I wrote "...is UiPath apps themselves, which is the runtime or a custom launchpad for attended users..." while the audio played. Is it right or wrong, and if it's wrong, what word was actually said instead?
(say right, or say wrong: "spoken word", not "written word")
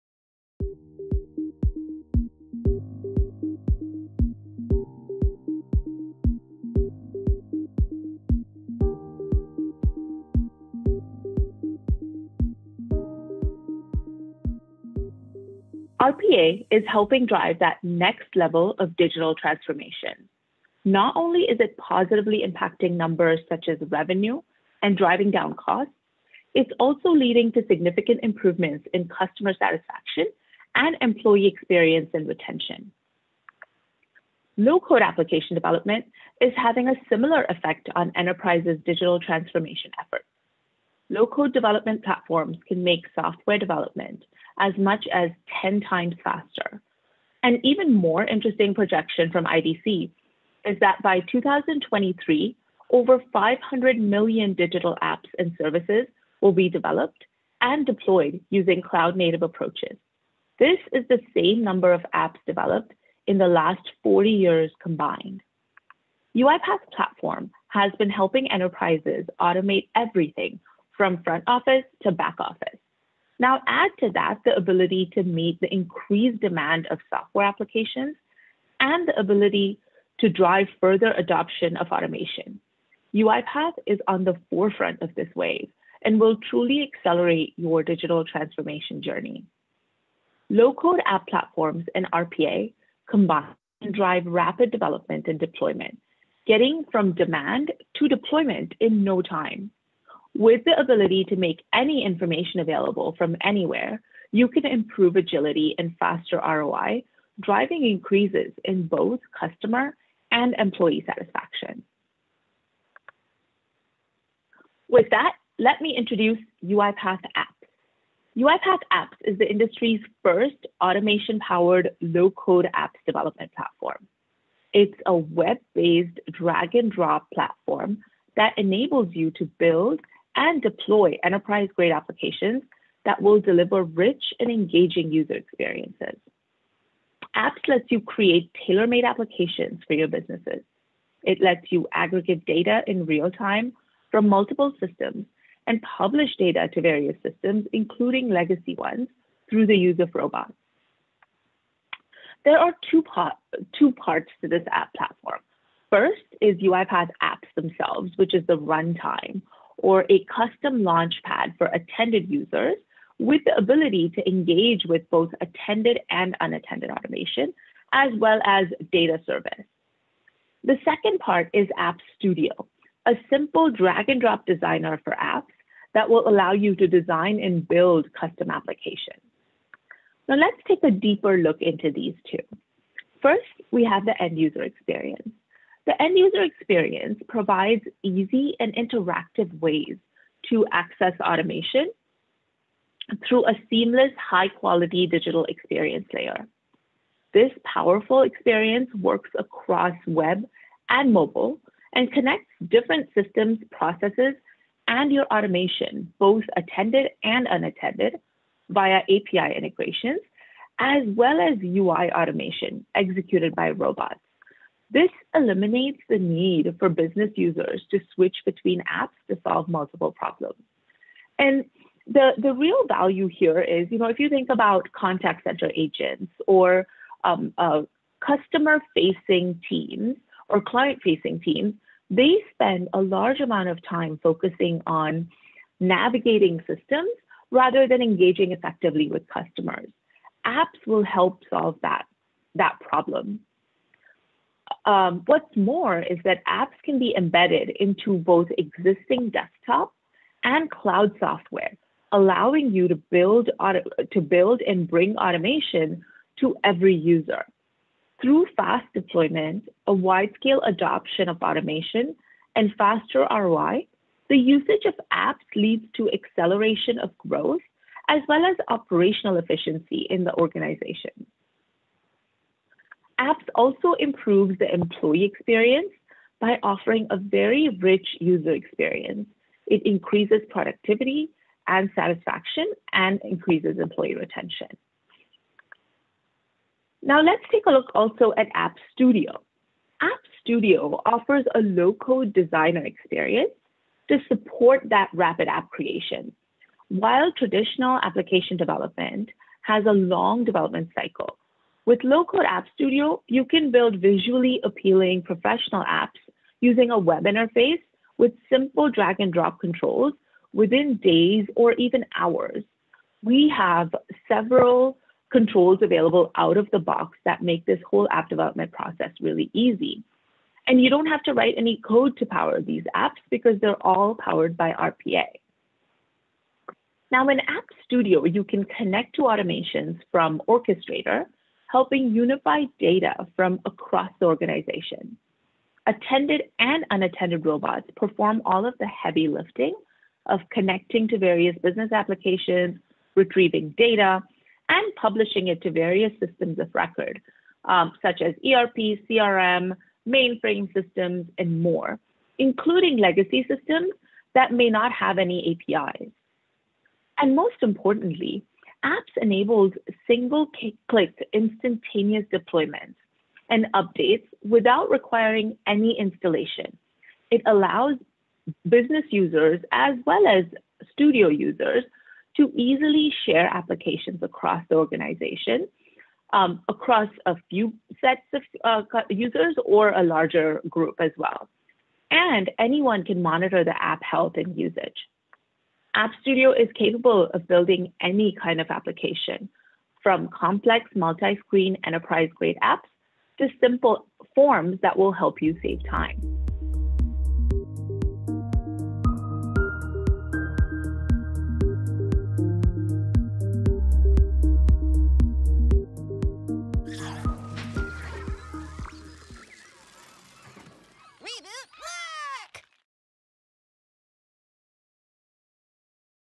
right.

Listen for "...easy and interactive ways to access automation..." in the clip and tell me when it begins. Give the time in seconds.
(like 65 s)
188 s.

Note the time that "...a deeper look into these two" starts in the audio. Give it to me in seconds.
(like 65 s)
180 s.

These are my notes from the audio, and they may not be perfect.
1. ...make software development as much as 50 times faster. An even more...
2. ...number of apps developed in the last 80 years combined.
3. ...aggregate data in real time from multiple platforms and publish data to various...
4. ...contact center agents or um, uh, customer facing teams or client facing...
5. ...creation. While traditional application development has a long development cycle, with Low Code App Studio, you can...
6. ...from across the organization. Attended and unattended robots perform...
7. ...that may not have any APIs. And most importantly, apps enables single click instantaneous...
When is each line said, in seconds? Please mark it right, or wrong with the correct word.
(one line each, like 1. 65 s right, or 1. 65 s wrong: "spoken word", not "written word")
1. 42 s wrong: "10", not "50"
2. 61 s wrong: "40", not "80"
3. 141 s wrong: "systems", not "platforms"
4. 224 s right
5. 295 s right
6. 333 s right
7. 354 s right.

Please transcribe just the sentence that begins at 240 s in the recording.
Apps will help solve that, that problem.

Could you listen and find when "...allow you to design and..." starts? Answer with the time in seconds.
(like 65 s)
176 s.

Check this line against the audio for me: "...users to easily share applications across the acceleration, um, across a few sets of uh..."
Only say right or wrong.
wrong.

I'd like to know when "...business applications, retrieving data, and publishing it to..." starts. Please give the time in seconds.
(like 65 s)
341 s.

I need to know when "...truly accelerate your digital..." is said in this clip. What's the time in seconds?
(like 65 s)
86 s.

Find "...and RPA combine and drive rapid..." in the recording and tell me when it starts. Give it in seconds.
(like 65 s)
91 s.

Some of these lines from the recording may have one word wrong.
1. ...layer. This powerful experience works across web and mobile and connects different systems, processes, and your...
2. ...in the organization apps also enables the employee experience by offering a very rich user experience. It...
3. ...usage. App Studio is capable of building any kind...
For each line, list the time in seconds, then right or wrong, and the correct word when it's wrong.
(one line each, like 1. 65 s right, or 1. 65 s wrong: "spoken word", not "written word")
1. 196 s right
2. 270 s wrong: "improves", not "enables"
3. 384 s right.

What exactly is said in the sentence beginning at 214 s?
This eliminates the need for business users to switch between apps to solve multiple problems.